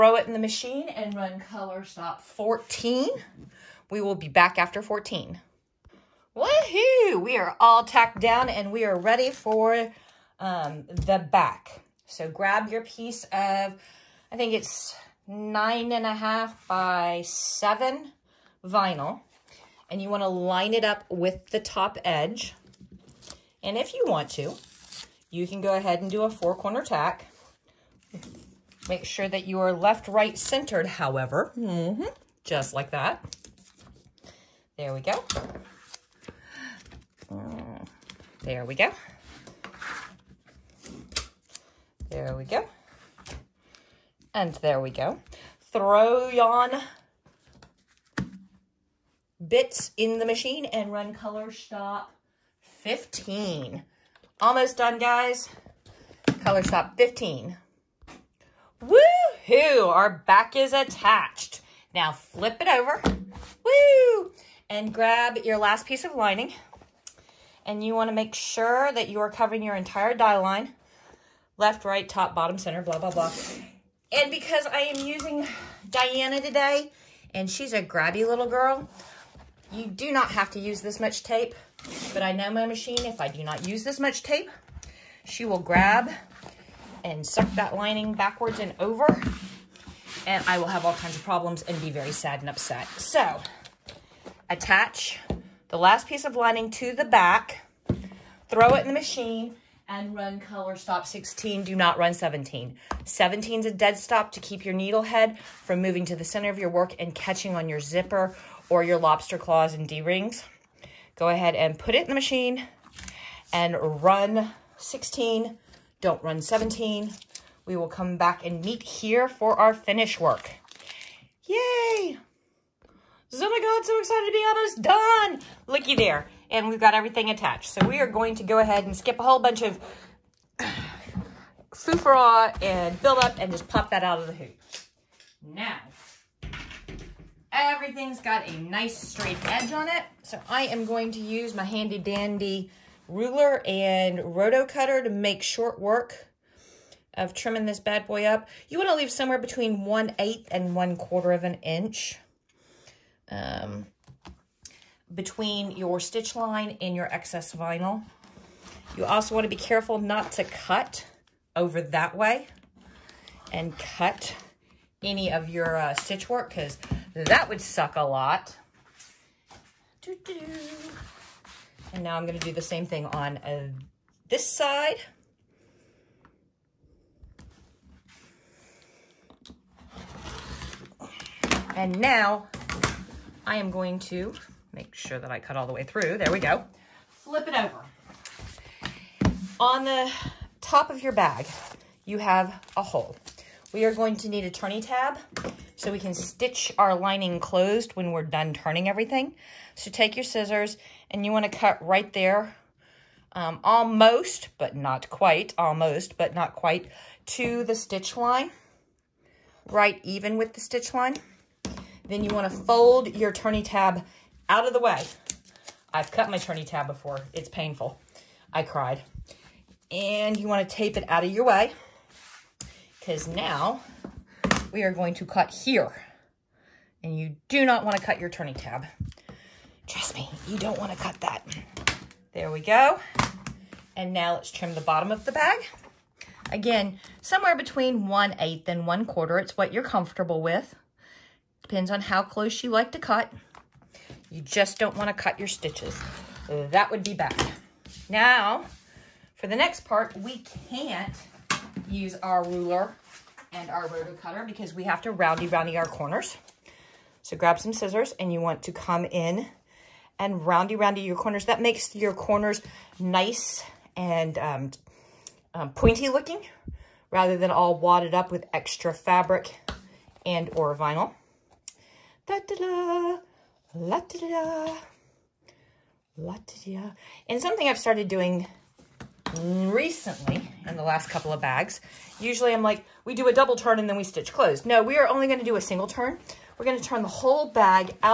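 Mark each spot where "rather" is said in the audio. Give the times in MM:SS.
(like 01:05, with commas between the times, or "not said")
04:27.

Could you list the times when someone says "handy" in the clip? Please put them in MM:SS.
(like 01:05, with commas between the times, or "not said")
02:21.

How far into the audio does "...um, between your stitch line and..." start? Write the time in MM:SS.
02:33.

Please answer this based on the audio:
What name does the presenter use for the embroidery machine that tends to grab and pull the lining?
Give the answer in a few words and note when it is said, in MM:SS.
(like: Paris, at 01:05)
Diana, at 01:15.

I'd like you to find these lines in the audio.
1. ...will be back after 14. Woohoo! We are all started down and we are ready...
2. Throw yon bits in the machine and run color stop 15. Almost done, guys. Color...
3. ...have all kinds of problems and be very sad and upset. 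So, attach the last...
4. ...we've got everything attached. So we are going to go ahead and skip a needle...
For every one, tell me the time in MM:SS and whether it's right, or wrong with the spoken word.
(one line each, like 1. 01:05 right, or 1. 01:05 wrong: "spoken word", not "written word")
1. 00:04 wrong: "tacked", not "started"
2. 00:45 right
3. 01:30 right
4. 02:06 wrong: "whole", not "needle".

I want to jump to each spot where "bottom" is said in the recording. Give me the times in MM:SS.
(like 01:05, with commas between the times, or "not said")
01:12, 03:54.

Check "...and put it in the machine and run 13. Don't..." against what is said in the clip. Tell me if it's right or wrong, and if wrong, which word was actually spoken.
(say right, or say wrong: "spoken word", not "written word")
wrong: "16", not "13".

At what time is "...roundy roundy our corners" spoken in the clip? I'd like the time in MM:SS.
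04:15.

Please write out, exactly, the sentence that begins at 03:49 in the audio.
Trust me, you don't want to cut that.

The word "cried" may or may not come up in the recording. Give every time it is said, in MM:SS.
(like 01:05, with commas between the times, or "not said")
03:38.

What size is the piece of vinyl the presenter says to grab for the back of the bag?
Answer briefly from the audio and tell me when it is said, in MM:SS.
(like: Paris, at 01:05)
9.5 by 7, at 00:15.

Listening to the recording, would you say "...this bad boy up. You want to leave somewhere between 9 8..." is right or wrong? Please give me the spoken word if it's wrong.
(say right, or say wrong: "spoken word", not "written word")
wrong: "1", not "9".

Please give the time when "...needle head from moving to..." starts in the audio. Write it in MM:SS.
01:44.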